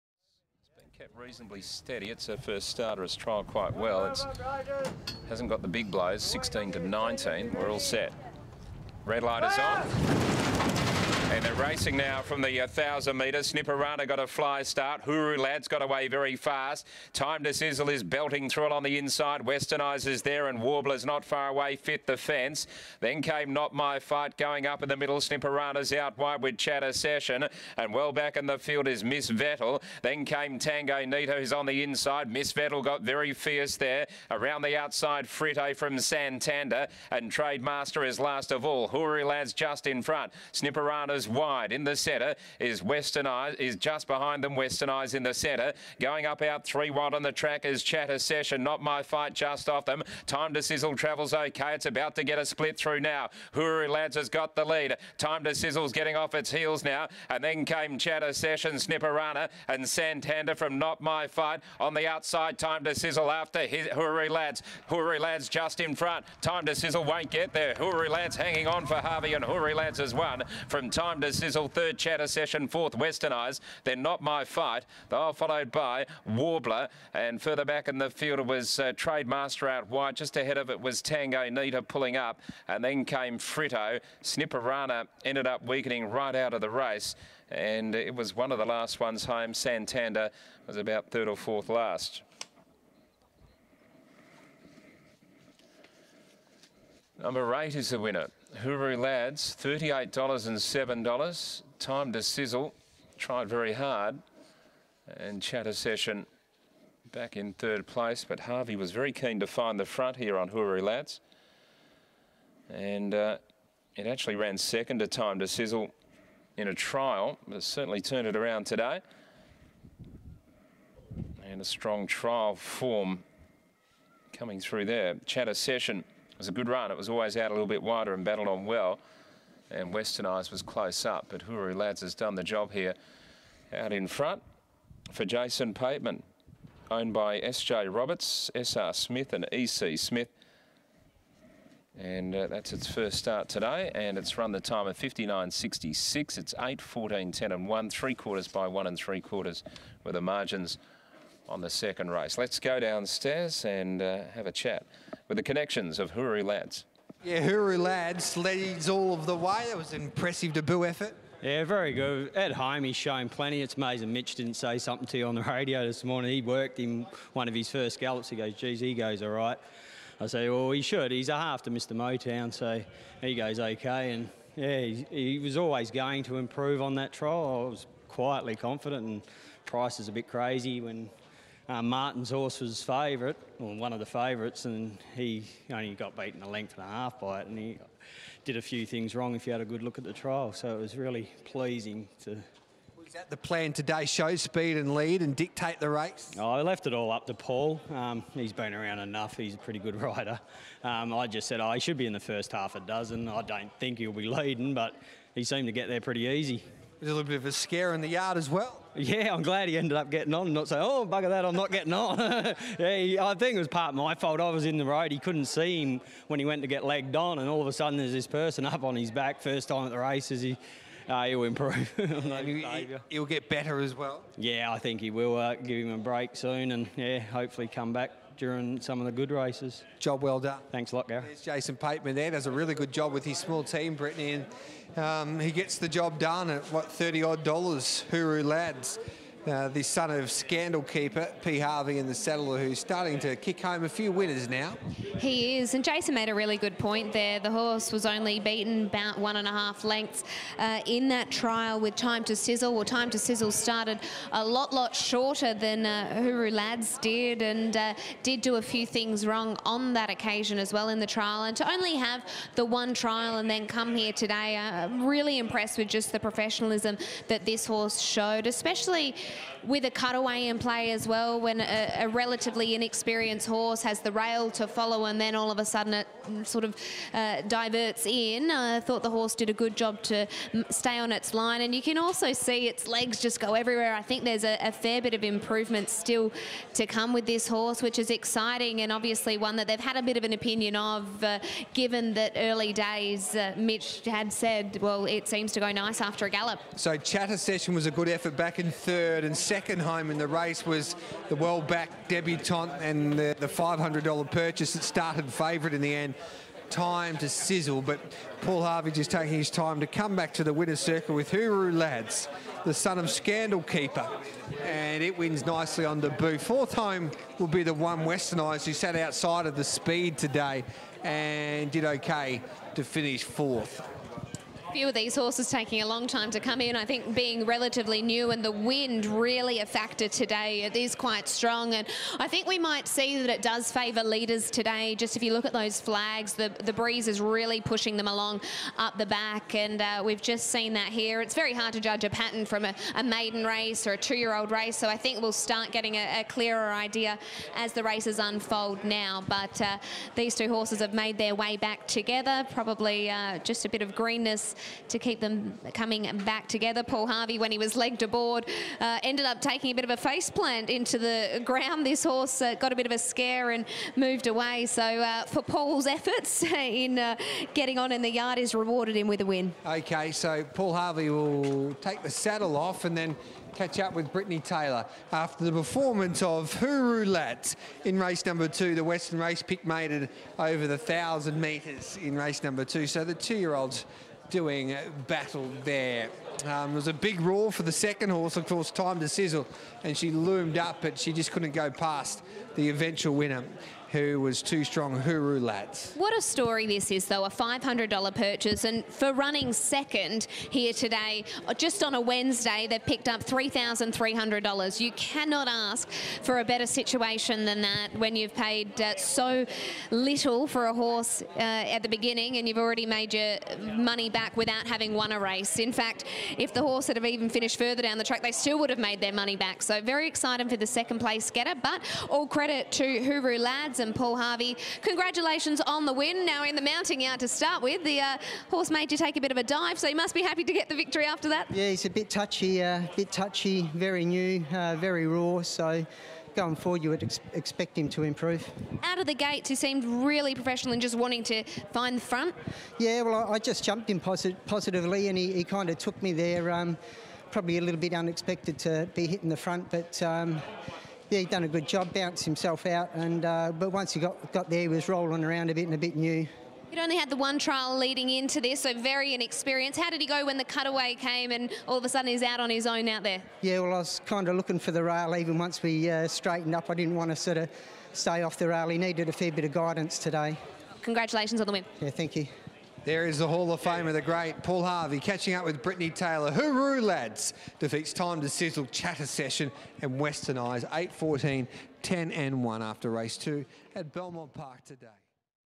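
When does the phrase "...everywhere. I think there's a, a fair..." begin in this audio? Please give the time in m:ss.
4:43.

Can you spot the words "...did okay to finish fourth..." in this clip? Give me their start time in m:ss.
5:21.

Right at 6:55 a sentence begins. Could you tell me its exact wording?
In fact, if the horse had have even finished further down the track, they still would have made their money back.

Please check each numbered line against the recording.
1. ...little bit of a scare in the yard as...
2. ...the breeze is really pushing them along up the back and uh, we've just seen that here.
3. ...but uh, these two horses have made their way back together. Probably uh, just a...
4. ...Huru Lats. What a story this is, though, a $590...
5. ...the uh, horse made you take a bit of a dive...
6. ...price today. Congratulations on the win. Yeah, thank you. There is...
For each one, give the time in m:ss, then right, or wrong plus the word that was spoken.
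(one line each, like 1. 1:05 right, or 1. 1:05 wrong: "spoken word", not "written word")
1. 3:27 right
2. 5:36 right
3. 5:49 right
4. 6:35 wrong: "500", not "590"
5. 7:07 right
6. 7:49 wrong: "guidance", not "price".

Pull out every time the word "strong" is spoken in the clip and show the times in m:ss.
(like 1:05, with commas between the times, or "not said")
2:01, 5:31, 6:34.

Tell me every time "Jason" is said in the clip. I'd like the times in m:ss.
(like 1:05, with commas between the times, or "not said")
2:15, 3:51, 4:05.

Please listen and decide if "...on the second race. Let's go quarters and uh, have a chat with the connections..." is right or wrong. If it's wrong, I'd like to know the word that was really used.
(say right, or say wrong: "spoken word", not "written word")
wrong: "downstairs", not "quarters".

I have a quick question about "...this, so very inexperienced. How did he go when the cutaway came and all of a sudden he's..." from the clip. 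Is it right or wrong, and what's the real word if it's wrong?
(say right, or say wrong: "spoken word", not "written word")
right.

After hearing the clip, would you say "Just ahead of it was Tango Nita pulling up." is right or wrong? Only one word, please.
right.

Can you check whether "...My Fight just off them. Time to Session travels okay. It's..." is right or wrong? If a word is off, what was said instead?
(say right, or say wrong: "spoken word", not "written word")
wrong: "Sizzle", not "Session".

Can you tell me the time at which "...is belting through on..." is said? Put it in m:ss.
0:17.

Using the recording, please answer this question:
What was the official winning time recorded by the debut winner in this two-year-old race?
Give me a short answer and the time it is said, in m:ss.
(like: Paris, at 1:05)
59.66, at 2:24.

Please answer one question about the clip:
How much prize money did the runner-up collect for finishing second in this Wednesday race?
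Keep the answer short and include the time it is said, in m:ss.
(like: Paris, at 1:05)
$3,300, at 6:43.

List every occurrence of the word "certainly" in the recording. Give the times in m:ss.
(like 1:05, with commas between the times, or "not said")
1:57.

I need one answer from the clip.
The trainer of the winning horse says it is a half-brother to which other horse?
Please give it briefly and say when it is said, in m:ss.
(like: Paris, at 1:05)
Mr Motown, at 2:51.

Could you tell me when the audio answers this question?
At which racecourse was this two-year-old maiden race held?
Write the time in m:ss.
8:03.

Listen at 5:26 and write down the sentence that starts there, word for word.
I think being relatively new and the wind really a factor today.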